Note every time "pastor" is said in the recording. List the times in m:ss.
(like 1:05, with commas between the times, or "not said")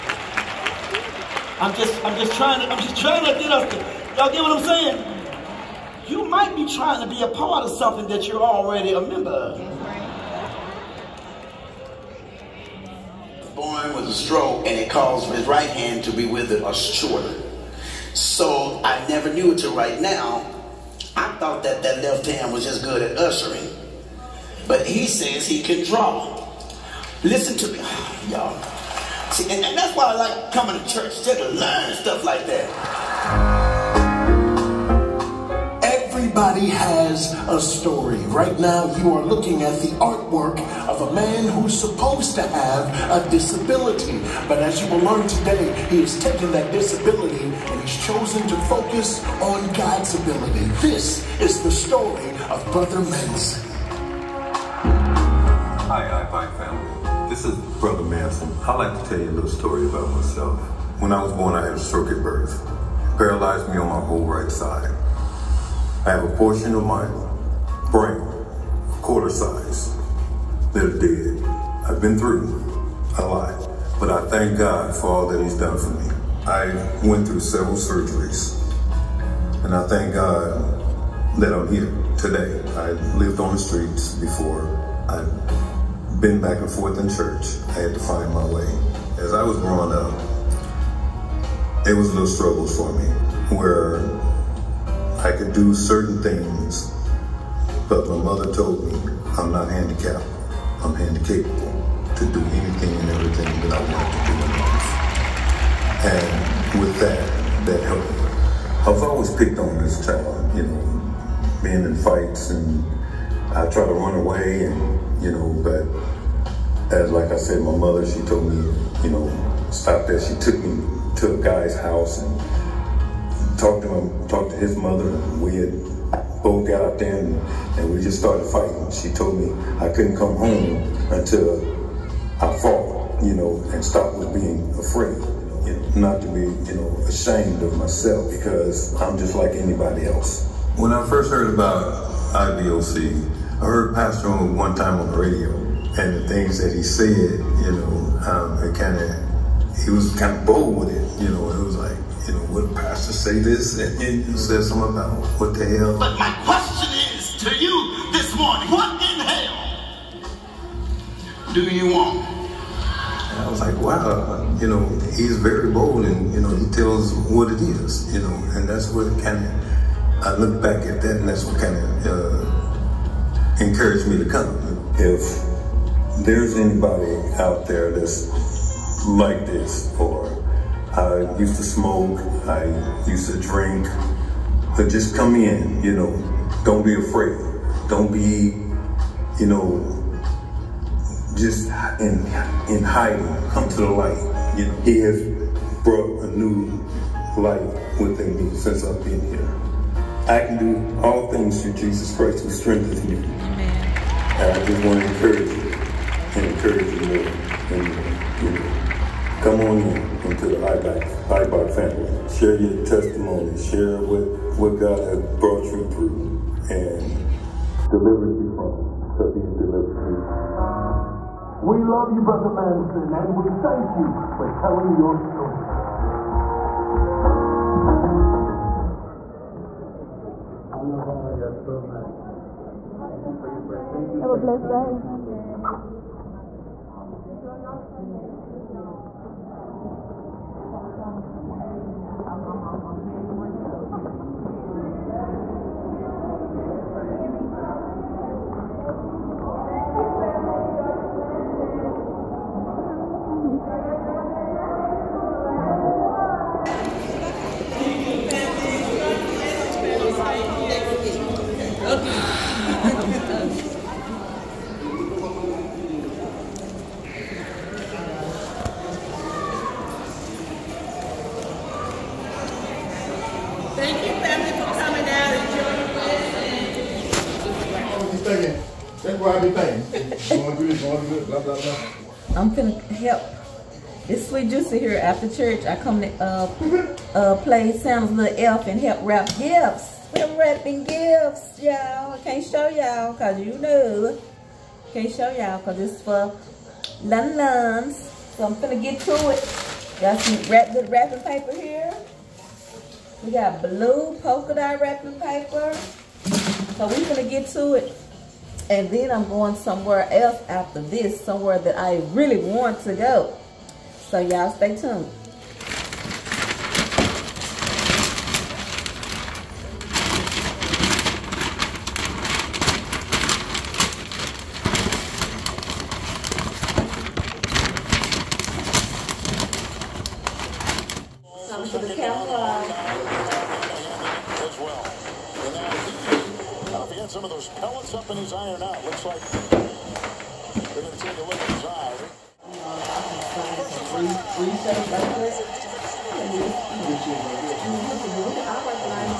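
2:23, 2:32.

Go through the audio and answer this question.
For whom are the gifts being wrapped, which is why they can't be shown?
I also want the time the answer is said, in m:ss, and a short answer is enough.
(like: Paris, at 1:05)
Lun Luns, at 4:57.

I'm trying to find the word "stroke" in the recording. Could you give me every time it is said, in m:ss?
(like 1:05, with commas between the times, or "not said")
0:14, 1:01.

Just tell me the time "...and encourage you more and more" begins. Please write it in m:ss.
3:26.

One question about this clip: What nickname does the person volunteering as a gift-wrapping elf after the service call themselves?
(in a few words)
Sweet Juicy.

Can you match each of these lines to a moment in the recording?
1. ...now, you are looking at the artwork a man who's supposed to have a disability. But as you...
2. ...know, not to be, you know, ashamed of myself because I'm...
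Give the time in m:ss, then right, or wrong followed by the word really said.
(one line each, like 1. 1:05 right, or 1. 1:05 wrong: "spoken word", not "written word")
1. 0:38 right
2. 2:15 right.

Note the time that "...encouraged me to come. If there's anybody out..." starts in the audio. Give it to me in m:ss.
2:53.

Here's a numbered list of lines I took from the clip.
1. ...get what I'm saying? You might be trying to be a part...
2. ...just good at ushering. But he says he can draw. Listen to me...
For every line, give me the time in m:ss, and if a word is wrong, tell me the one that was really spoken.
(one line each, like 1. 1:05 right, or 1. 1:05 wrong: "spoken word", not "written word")
1. 0:04 right
2. 0:22 right.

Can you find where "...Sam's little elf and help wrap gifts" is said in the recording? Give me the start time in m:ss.
4:47.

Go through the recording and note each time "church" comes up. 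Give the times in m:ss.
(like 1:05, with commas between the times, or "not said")
0:30, 1:27, 4:45.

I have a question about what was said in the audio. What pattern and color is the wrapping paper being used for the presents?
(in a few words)
Blue polka dot.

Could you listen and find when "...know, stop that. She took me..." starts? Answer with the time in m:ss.
1:59.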